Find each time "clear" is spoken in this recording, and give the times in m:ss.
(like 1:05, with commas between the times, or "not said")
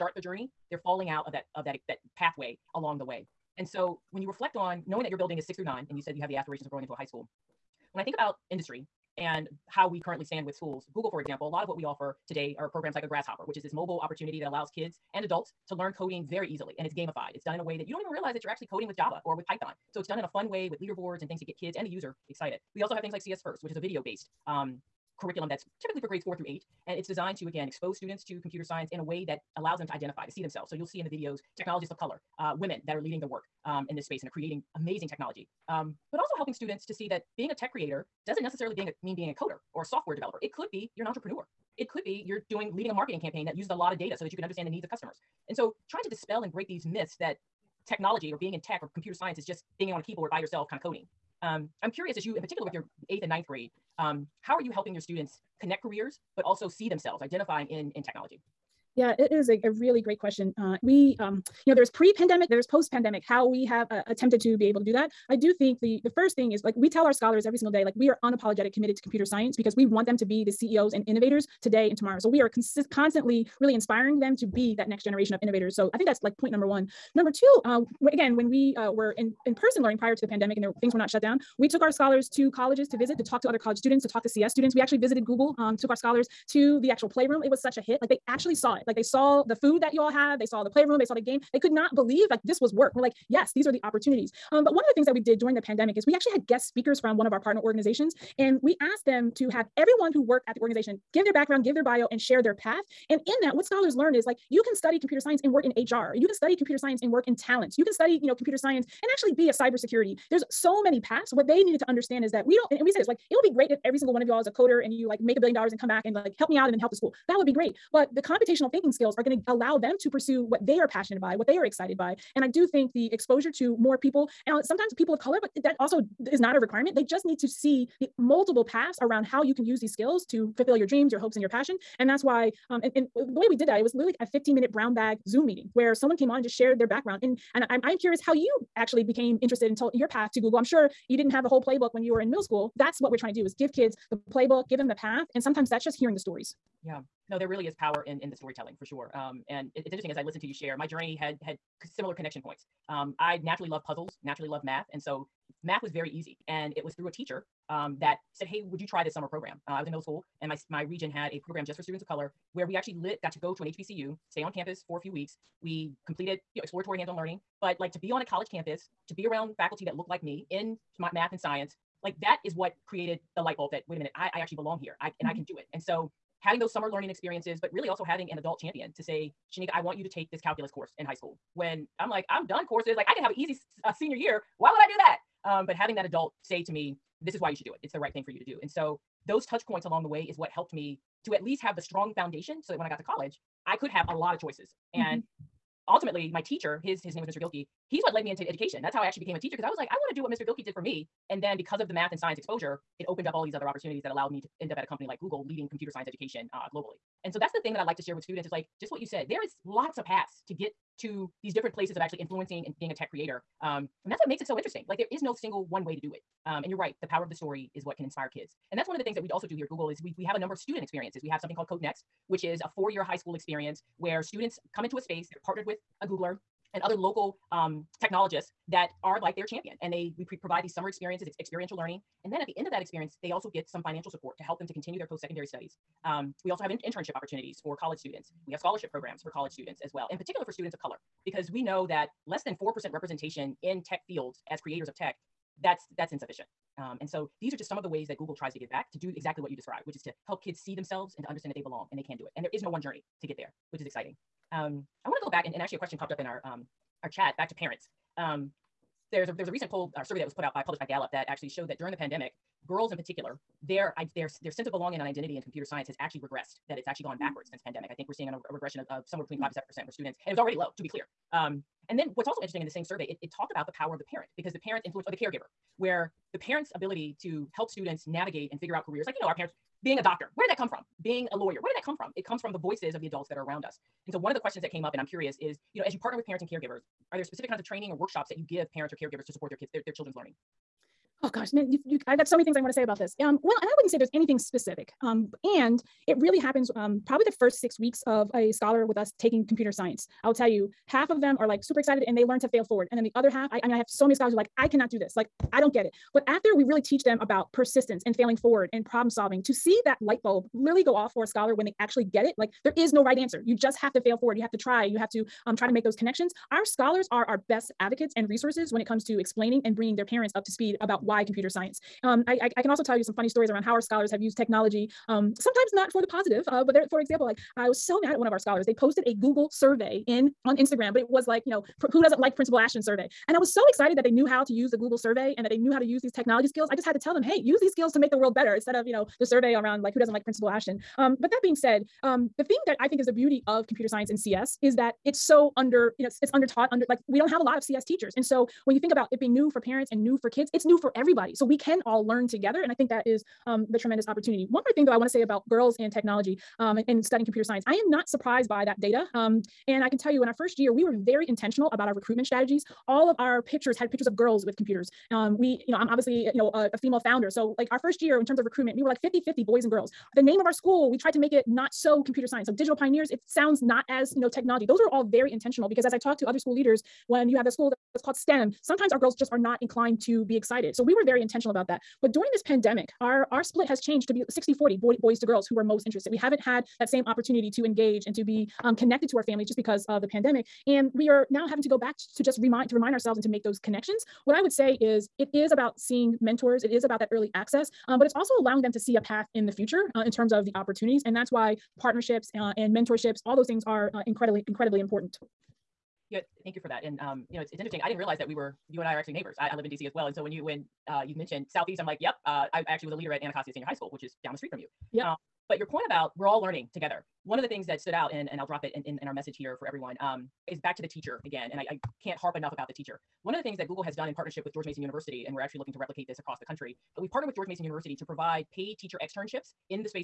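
4:30.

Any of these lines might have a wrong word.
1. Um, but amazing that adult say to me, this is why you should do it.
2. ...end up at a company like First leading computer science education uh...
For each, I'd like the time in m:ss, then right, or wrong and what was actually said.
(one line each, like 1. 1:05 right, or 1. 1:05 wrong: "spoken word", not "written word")
1. 3:05 wrong: "having", not "amazing"
2. 3:24 wrong: "Google", not "First".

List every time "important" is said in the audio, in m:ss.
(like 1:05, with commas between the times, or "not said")
6:44.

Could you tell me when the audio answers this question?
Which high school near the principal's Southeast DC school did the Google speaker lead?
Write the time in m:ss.
6:53.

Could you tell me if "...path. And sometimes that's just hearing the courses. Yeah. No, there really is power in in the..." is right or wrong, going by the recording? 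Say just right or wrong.
wrong.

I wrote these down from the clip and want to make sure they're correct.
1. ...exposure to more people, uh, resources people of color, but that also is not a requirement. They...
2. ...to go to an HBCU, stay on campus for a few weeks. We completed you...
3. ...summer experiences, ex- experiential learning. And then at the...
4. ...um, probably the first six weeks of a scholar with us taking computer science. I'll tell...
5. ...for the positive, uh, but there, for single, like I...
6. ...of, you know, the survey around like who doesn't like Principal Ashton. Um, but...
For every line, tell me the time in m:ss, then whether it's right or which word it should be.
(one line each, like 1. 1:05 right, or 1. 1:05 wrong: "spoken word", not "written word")
1. 2:03 wrong: "sometimes", not "resources"
2. 2:43 right
3. 3:50 right
4. 4:56 right
5. 5:25 wrong: "example", not "single"
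6. 5:38 right.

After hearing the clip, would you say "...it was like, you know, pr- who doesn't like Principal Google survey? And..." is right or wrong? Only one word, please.
wrong.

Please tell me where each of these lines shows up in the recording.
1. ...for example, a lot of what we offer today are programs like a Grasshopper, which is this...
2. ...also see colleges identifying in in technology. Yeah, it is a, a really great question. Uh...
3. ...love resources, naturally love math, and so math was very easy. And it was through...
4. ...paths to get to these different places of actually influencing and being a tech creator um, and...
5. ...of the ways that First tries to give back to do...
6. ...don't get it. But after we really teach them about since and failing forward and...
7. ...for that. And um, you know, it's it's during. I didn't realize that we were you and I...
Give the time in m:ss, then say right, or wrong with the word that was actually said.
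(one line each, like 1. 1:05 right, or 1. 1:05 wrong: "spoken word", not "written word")
1. 0:11 right
2. 0:56 wrong: "themselves", not "colleges"
3. 2:33 wrong: "puzzles", not "resources"
4. 3:30 right
5. 4:07 wrong: "Google", not "First"
6. 5:05 wrong: "persistence", not "since"
7. 6:46 wrong: "interesting", not "during".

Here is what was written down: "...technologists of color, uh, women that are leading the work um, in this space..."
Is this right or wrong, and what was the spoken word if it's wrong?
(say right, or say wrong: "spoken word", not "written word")
right.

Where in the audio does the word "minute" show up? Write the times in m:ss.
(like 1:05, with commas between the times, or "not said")
2:14, 2:53.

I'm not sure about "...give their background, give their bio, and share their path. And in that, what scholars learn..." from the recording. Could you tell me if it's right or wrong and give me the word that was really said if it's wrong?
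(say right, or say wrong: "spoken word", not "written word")
right.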